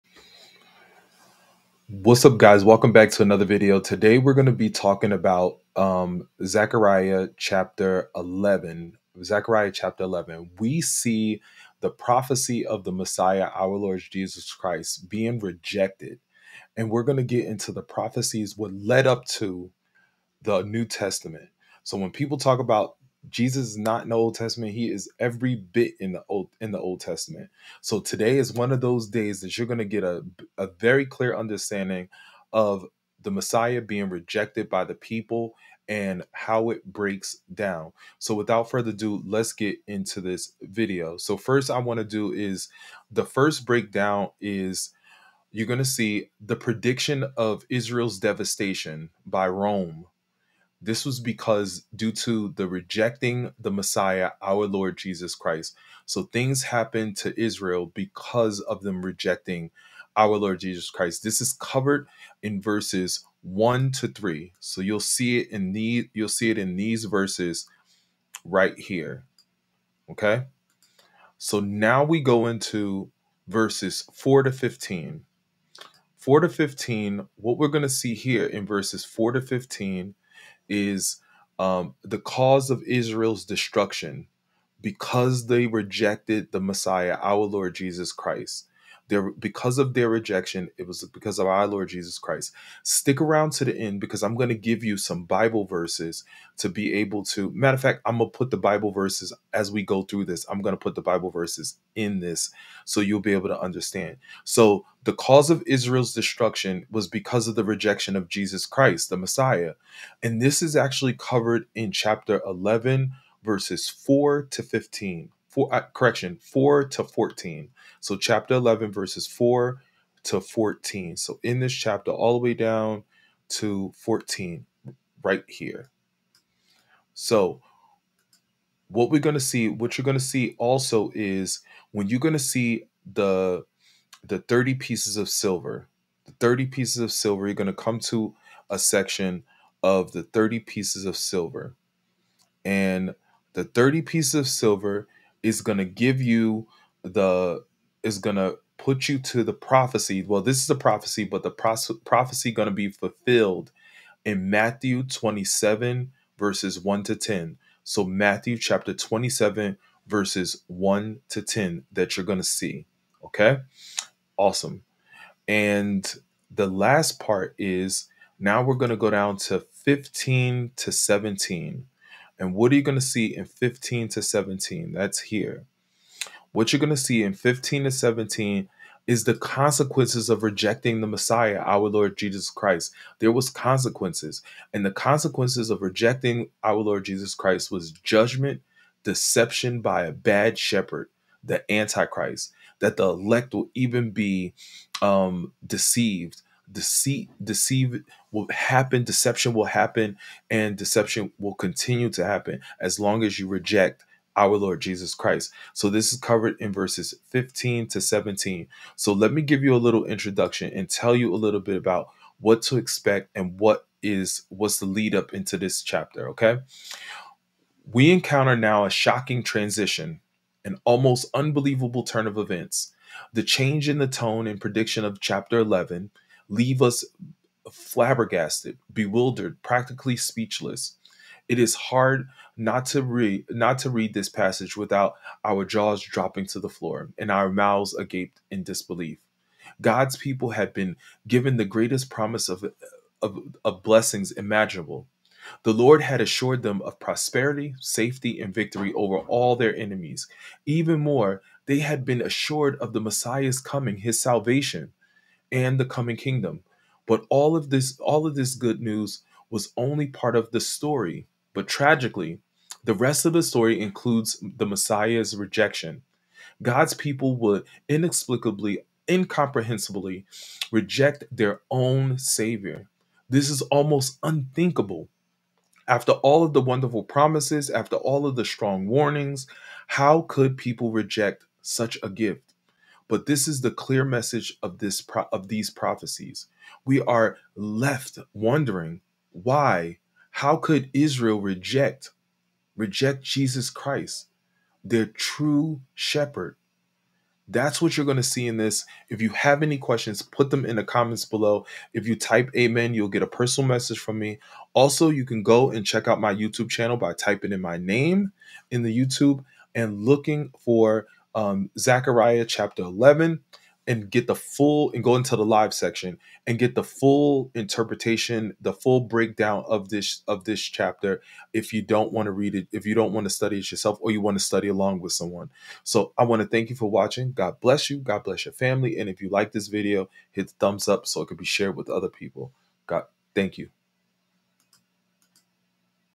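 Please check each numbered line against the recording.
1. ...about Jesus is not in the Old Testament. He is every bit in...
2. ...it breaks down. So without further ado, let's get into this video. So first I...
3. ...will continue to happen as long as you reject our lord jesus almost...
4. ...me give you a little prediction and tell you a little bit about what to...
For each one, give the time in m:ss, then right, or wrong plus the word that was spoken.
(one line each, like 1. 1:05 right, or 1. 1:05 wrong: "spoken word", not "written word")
1. 0:22 right
2. 0:36 right
3. 3:21 wrong: "christ", not "almost"
4. 3:29 wrong: "introduction", not "prediction".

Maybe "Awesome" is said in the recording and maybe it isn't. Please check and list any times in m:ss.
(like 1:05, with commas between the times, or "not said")
2:44.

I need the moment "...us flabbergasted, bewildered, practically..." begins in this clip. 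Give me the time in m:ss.
3:46.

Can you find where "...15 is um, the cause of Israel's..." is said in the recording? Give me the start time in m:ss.
1:19.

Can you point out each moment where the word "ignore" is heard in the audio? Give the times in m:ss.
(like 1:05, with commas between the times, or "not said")
not said.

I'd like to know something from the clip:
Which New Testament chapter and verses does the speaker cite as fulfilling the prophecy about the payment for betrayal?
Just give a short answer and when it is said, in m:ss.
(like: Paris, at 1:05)
Matthew 27:1-10, at 2:34.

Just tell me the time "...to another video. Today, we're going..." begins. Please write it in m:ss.
0:03.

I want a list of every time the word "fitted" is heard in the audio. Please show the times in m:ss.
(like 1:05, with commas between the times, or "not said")
not said.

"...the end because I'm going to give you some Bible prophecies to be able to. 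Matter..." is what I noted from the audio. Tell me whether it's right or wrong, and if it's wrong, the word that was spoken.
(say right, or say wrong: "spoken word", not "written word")
wrong: "verses", not "prophecies".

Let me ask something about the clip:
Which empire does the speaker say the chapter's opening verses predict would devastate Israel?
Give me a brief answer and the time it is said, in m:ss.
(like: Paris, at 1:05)
Rome, at 0:49.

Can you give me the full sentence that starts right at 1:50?
And this is actually covered in chapter 11, verses 4 to 15 four uh, correction four to fourteen.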